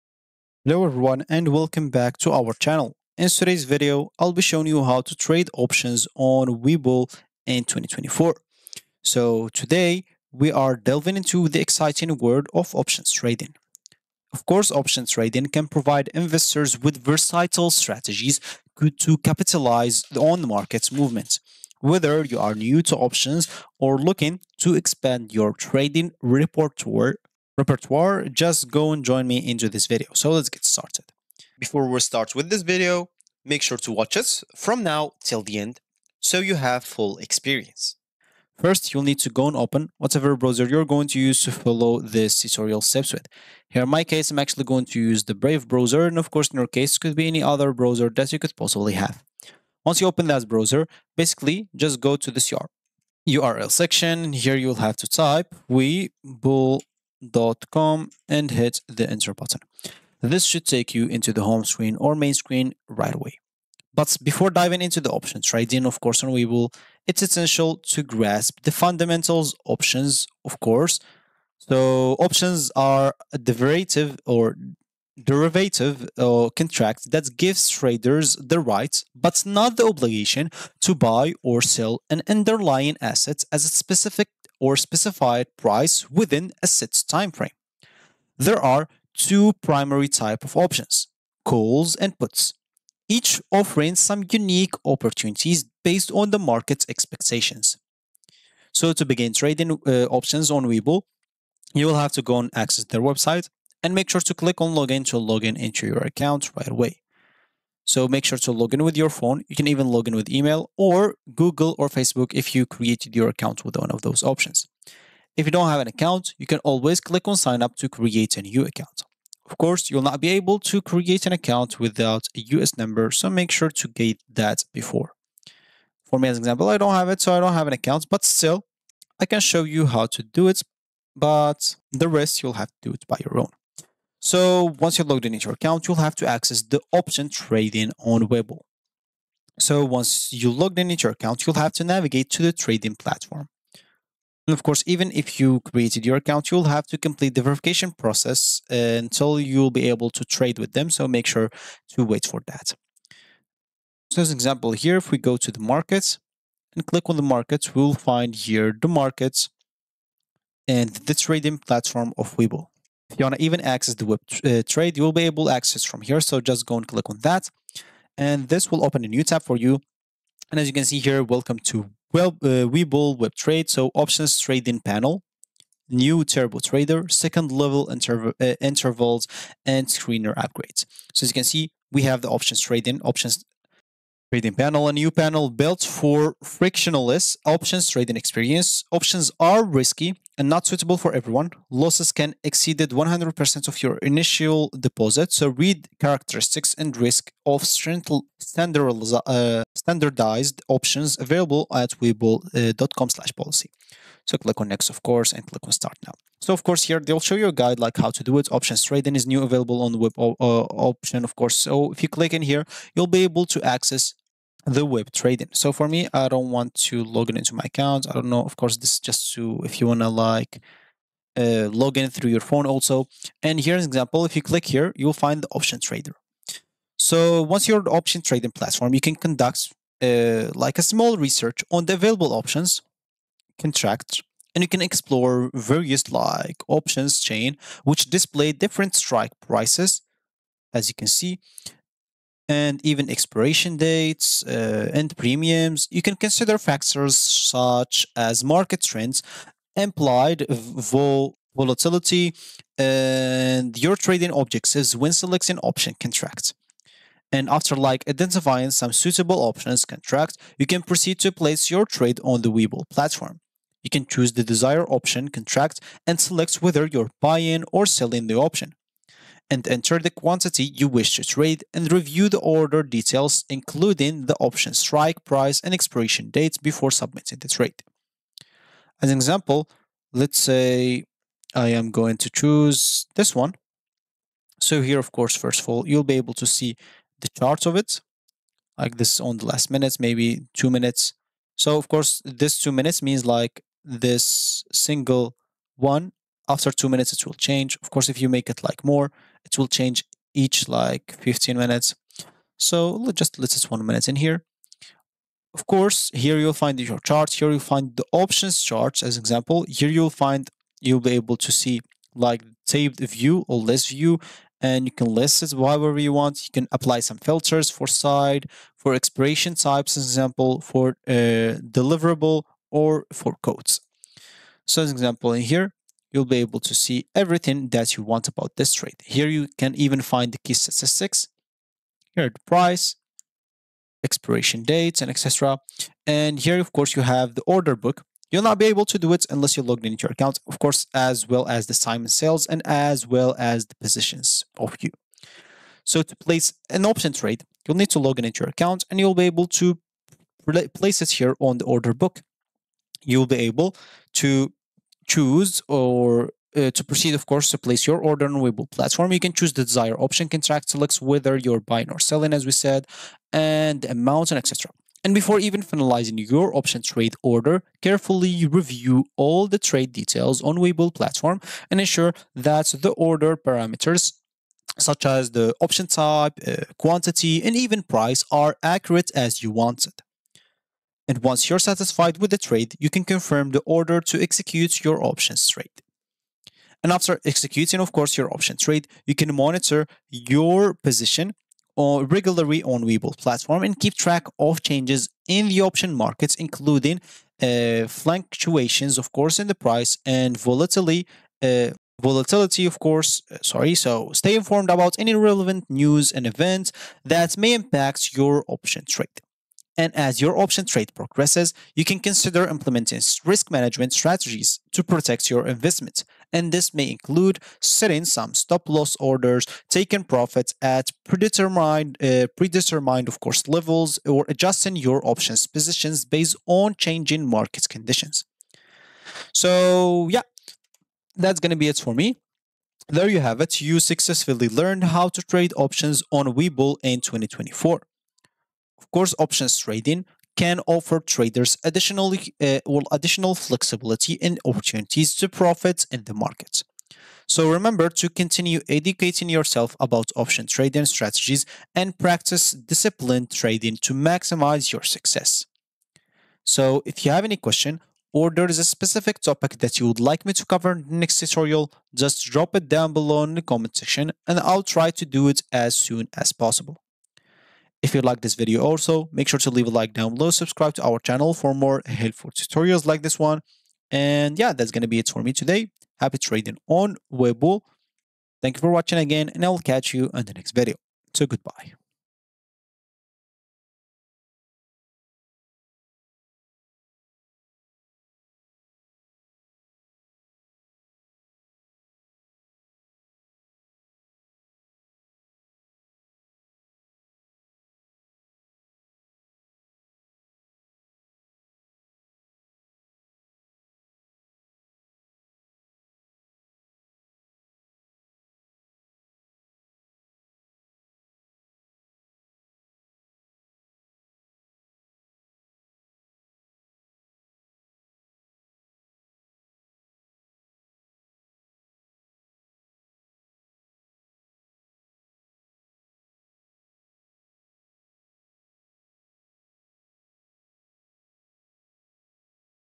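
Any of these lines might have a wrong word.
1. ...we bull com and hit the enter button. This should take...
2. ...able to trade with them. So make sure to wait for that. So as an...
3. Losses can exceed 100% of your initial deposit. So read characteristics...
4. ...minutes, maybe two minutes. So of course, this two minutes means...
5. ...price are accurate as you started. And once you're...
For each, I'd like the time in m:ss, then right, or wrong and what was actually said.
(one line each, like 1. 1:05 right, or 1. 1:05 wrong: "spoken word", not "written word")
1. 0:55 right
2. 2:29 right
3. 3:11 right
4. 4:49 right
5. 6:17 wrong: "wanted", not "started".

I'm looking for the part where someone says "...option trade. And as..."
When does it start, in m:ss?
6:48.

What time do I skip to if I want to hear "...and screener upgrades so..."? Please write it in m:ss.
2:59.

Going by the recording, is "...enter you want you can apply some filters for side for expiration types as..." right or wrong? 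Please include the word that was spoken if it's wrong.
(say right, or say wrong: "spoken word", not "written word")
wrong: "however", not "enter".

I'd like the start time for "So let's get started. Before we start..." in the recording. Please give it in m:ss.
0:30.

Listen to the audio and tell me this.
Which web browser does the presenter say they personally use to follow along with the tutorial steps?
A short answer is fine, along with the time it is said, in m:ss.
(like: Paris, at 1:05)
Brave, at 0:45.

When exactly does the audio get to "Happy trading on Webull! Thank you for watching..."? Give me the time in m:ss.
7:55.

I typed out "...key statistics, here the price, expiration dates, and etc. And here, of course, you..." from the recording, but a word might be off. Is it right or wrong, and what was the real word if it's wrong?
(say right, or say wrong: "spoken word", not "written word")
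right.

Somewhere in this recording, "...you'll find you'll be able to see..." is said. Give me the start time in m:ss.
5:09.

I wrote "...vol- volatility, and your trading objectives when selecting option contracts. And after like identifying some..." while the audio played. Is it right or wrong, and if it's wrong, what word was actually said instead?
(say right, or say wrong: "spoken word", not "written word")
right.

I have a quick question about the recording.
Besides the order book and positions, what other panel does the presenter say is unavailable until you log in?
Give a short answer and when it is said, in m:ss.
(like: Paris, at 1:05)
time and sales, at 5:41.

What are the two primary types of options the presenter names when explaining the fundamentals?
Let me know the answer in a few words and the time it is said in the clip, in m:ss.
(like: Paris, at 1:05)
calls and puts, at 1:31.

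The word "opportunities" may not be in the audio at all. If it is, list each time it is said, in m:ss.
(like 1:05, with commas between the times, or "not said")
1:34, 7:24.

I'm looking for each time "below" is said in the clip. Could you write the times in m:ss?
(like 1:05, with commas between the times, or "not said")
7:42, 7:50.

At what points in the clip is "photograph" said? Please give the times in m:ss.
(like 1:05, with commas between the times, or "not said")
not said.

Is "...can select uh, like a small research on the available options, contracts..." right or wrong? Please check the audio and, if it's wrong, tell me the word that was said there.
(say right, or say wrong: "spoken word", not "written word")
wrong: "conduct", not "select".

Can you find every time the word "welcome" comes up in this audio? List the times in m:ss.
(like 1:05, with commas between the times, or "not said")
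0:01, 2:51.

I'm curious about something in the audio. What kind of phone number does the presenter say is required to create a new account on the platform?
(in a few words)
US number.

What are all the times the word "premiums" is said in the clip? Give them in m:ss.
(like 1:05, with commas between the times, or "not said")
4:05.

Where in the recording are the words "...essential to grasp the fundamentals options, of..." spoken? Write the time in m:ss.
1:07.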